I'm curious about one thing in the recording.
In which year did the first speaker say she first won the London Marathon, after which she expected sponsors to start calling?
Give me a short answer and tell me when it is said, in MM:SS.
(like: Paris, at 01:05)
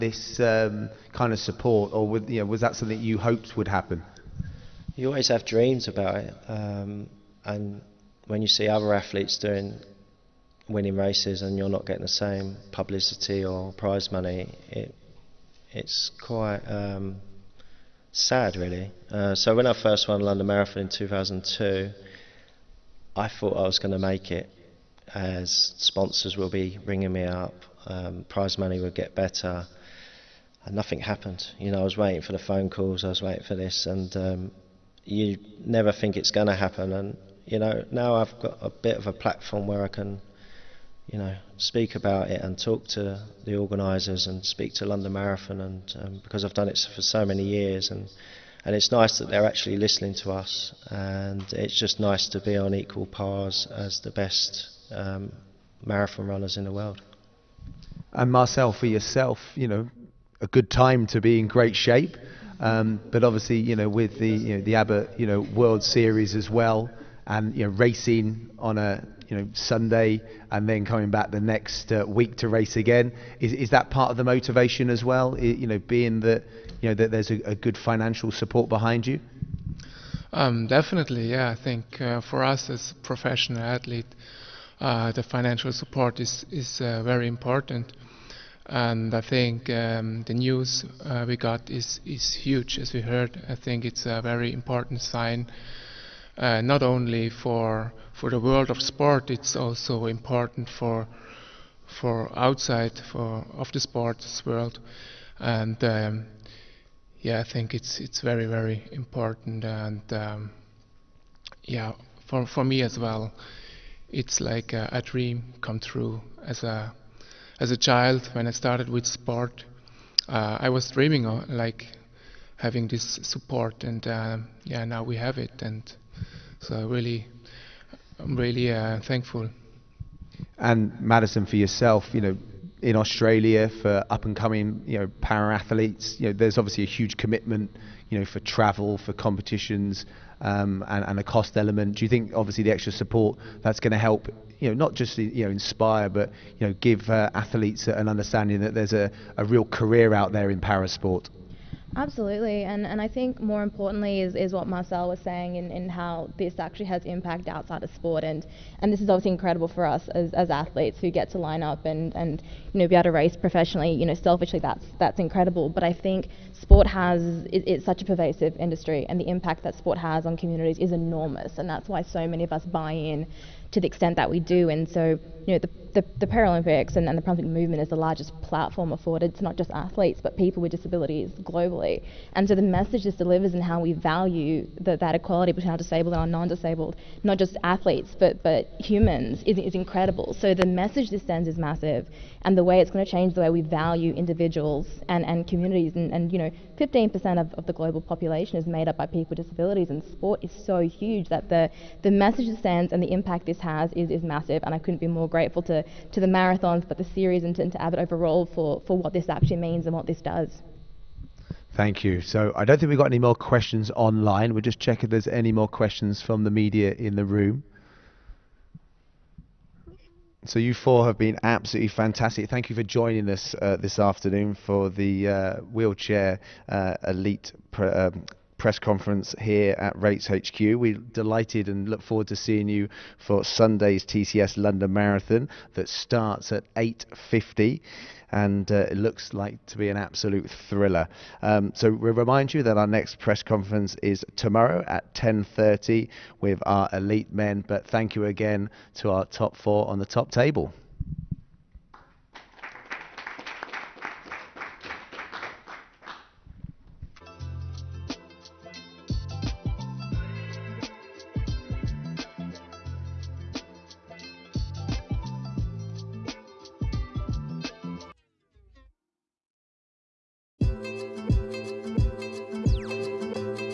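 2002, at 00:20.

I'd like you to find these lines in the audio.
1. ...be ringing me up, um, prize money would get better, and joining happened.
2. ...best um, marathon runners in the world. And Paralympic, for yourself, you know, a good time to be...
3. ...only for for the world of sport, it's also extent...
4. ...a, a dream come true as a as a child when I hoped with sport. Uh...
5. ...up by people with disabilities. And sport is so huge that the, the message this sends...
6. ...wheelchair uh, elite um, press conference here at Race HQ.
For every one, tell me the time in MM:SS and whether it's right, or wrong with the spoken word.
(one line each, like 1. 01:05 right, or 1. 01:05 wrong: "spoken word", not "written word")
1. 00:26 wrong: "nothing", not "joining"
2. 00:54 wrong: "Marcel", not "Paralympic"
3. 01:36 wrong: "important", not "extent"
4. 01:54 wrong: "started", not "hoped"
5. 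03:18 right
6. 03:45 right.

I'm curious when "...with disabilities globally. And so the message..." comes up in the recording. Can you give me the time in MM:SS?
03:00.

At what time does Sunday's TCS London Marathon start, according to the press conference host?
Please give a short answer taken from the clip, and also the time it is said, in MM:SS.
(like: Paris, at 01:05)
8:50, at 03:56.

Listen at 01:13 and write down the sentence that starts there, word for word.
Is, is that part of the motivation as well?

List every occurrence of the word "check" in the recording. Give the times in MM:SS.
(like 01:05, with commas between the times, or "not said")
03:34.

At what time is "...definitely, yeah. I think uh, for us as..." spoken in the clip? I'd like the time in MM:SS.
01:20.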